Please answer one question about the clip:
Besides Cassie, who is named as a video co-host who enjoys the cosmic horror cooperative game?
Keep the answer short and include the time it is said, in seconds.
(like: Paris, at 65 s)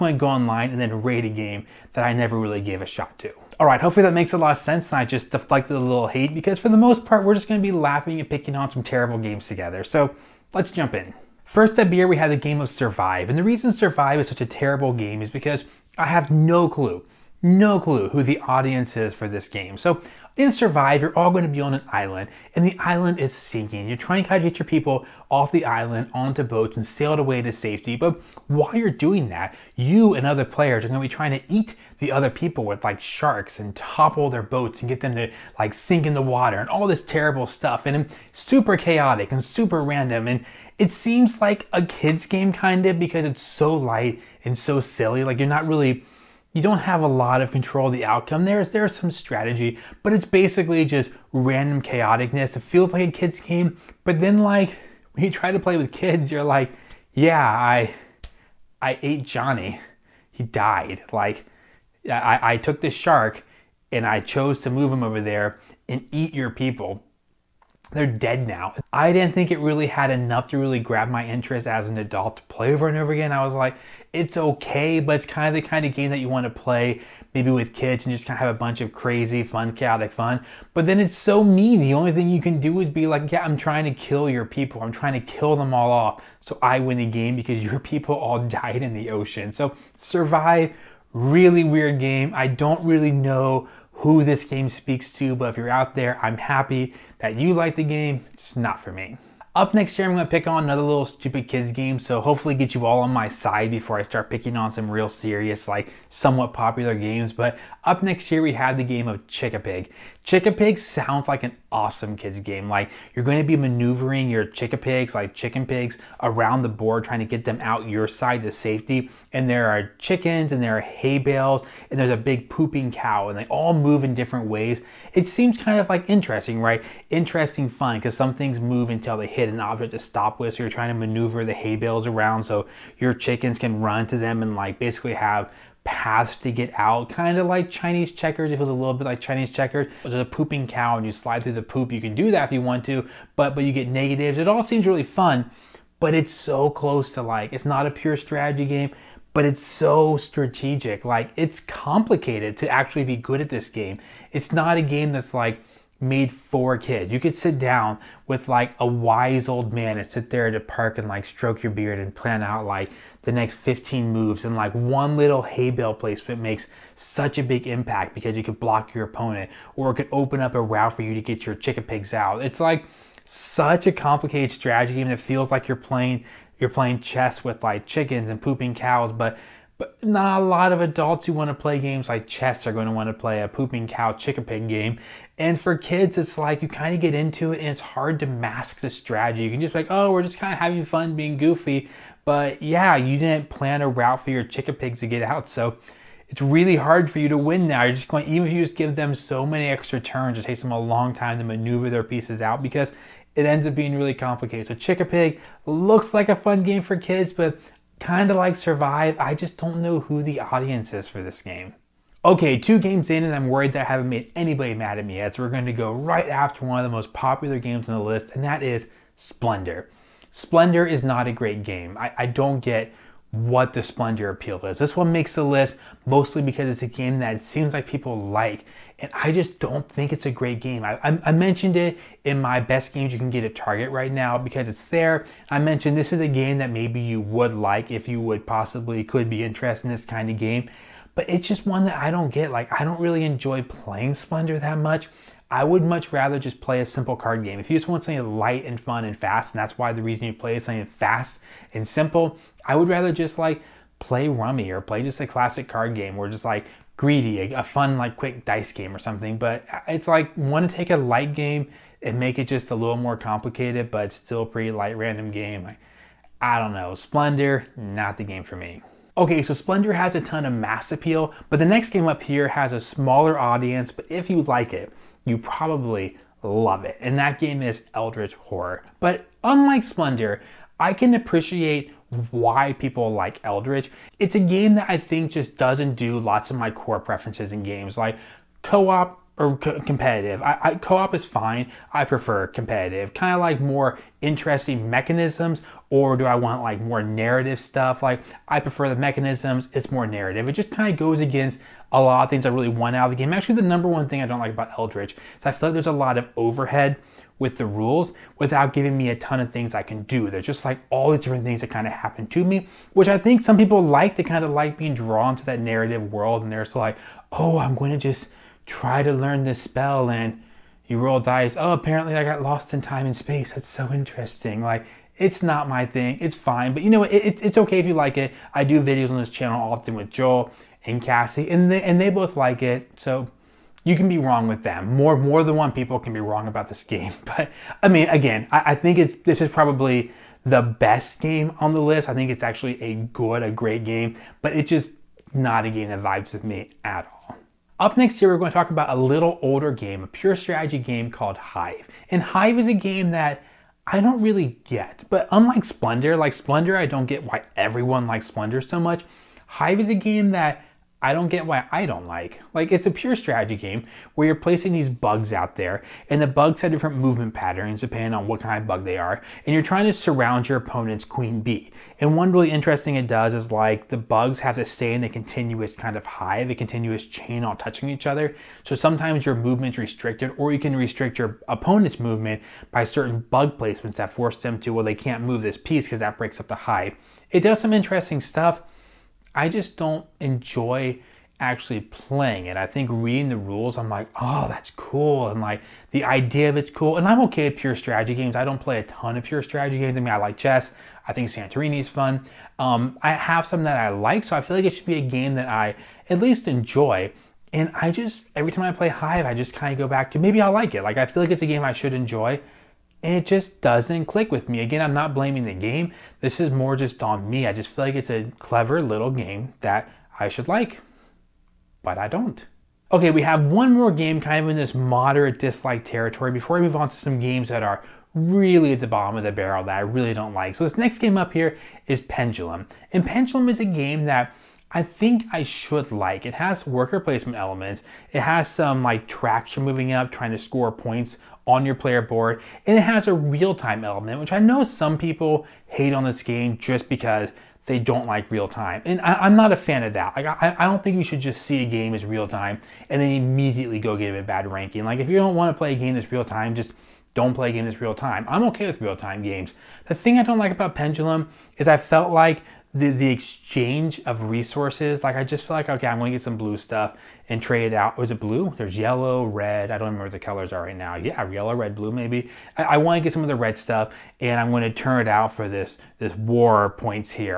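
Joel, at 330 s.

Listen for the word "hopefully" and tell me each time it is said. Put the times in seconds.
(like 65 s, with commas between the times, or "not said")
3 s, 102 s.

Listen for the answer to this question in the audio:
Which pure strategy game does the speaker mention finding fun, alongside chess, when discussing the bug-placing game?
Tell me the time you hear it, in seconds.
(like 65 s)
401 s.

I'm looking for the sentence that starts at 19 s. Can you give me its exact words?
So in Survive, you're all going to be on an island, and the island is sinking.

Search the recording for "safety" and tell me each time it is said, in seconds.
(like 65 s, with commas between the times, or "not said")
27 s, 118 s.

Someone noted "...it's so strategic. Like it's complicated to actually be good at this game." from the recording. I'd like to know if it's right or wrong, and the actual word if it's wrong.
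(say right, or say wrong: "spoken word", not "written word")
right.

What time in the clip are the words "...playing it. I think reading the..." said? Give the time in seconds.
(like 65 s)
391 s.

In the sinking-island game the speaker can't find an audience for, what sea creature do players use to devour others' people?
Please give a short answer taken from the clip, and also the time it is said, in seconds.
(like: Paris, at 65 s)
sharks, at 33 s.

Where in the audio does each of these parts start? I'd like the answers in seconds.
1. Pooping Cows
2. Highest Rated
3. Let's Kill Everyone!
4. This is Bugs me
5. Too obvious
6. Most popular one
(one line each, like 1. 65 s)
1. 99 s
2. 269 s
3. 11 s
4. 347 s
5. 422 s
6. 212 s.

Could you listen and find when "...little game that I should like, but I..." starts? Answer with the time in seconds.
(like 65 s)
418 s.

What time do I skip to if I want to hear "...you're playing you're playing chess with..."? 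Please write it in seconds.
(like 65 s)
175 s.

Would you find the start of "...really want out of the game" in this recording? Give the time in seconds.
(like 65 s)
302 s.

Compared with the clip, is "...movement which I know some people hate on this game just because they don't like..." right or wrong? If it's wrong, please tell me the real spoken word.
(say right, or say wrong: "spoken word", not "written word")
wrong: "element", not "movement".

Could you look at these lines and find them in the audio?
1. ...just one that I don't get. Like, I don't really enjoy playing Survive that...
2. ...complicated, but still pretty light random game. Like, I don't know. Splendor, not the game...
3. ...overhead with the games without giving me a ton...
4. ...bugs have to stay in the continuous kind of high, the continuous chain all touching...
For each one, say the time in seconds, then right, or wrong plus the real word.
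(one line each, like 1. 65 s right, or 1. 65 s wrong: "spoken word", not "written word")
1. 241 s wrong: "Splendor", not "Survive"
2. 263 s right
3. 306 s wrong: "rules", not "games"
4. 373 s right.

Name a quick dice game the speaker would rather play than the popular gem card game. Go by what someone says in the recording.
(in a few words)
Greedy.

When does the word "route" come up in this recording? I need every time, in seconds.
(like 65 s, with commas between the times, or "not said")
170 s, 193 s.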